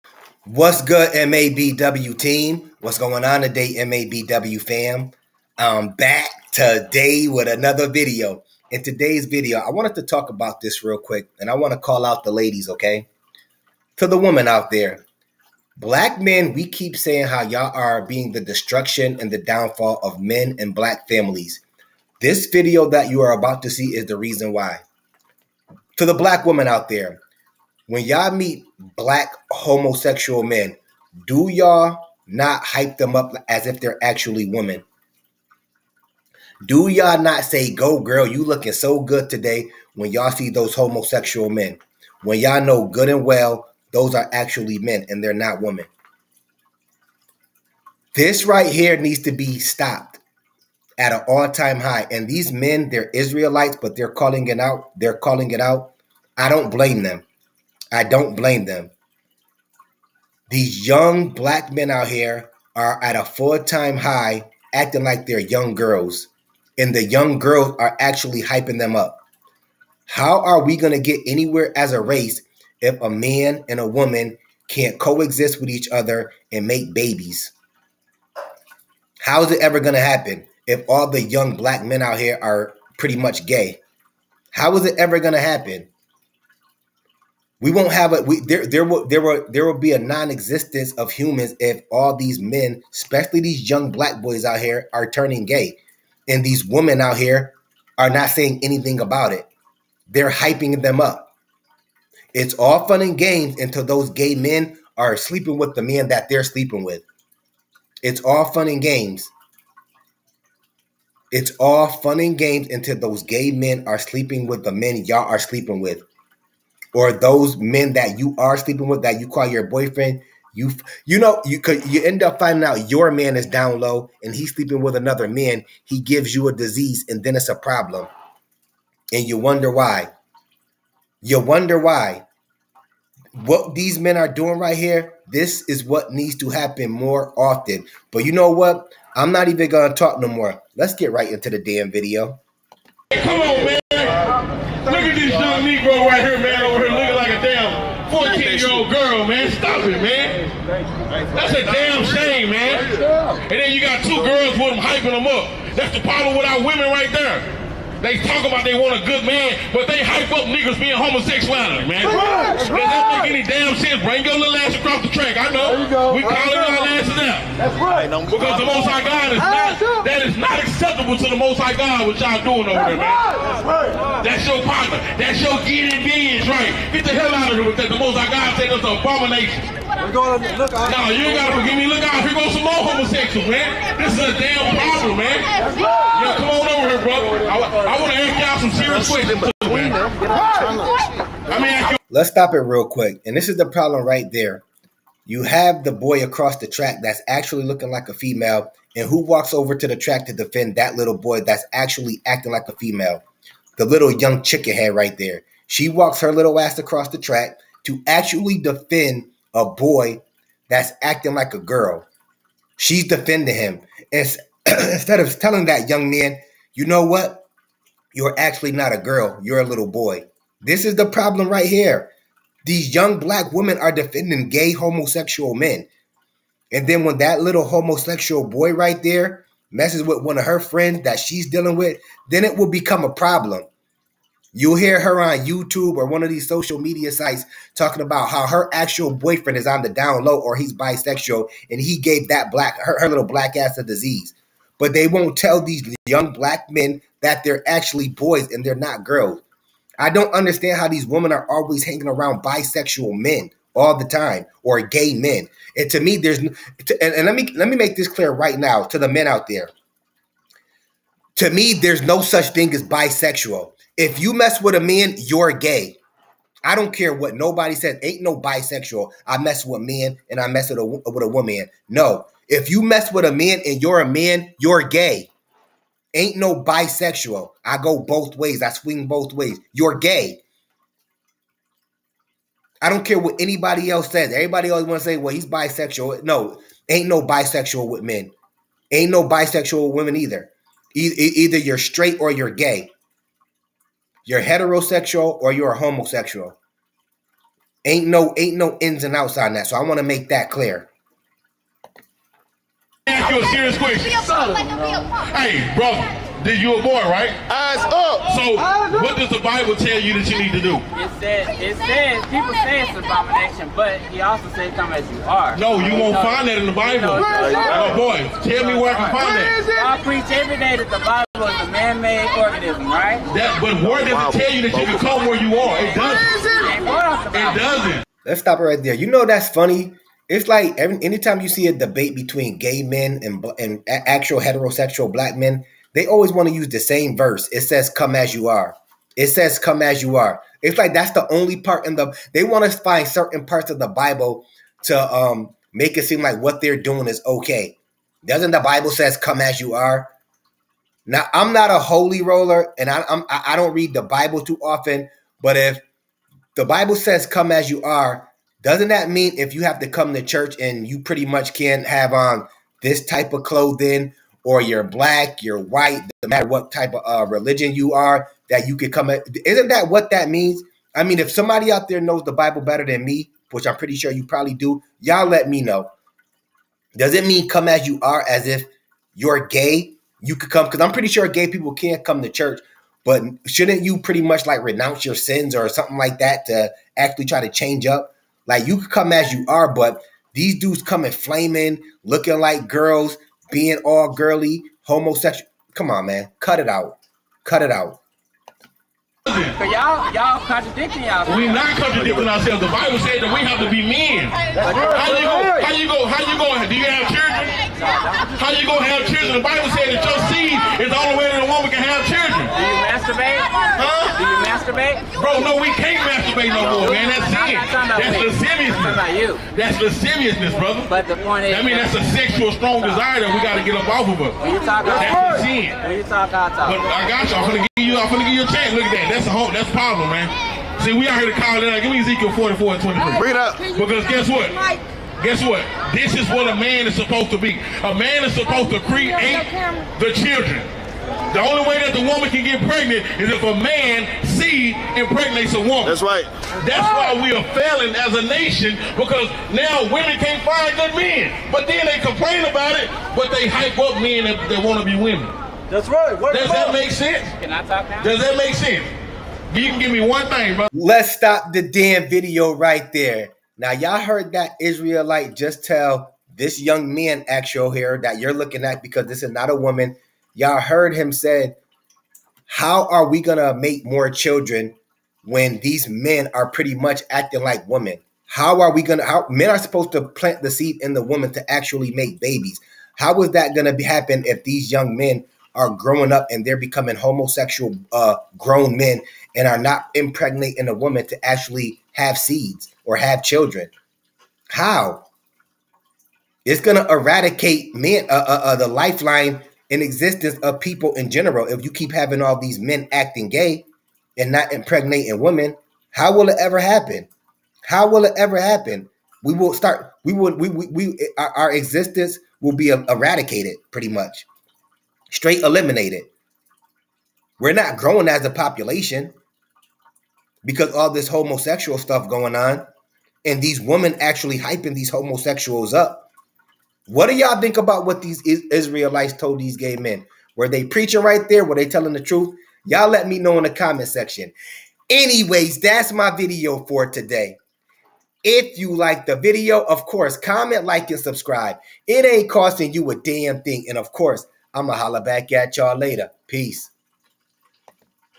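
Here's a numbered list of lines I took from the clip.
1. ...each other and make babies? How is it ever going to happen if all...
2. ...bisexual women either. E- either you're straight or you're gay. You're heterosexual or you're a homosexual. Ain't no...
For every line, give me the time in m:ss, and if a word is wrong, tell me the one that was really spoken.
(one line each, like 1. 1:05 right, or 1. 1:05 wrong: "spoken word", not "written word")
1. 1:15 right
2. 4:49 right.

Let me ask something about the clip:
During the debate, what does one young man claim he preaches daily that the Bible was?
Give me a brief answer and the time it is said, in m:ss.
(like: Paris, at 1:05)
a man-made organism, at 5:21.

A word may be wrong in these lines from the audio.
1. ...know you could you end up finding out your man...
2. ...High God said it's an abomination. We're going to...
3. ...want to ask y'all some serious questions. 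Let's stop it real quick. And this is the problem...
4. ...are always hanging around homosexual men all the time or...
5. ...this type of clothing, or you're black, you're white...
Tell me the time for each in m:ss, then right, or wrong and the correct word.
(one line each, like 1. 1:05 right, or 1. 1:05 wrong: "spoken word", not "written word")
1. 2:01 right
2. 2:58 right
3. 3:08 right
4. 4:11 wrong: "bisexual", not "homosexual"
5. 6:02 right.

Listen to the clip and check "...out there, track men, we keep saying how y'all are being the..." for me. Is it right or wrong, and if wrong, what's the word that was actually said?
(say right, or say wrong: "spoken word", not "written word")
wrong: "black", not "track".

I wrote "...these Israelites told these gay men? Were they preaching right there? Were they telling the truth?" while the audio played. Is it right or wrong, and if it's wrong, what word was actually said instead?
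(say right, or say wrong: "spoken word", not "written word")
right.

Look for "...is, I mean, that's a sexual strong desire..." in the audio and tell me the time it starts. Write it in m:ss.
7:01.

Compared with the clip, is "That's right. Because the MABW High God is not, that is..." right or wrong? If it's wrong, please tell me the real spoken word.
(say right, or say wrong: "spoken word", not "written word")
wrong: "Most", not "MABW".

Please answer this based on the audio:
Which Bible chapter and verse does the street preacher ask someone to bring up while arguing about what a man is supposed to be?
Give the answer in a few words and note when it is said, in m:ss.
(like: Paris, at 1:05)
Ezekiel 44:23, at 7:12.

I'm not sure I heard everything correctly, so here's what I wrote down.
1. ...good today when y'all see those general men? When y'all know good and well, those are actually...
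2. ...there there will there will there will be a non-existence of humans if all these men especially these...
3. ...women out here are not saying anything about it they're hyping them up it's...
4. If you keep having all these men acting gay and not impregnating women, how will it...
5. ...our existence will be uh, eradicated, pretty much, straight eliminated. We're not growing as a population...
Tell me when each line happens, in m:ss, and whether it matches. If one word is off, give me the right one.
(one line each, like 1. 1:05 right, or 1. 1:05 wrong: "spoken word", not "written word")
1. 0:39 wrong: "homosexual", not "general"
2. 1:28 right
3. 1:36 right
4. 8:21 right
5. 8:31 right.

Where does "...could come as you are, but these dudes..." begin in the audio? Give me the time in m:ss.
6:28.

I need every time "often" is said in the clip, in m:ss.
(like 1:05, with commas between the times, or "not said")
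2:17, 5:54.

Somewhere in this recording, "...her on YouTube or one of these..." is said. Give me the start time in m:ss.
3:54.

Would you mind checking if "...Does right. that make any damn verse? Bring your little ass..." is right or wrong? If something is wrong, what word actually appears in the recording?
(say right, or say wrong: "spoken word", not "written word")
wrong: "sense", not "verse".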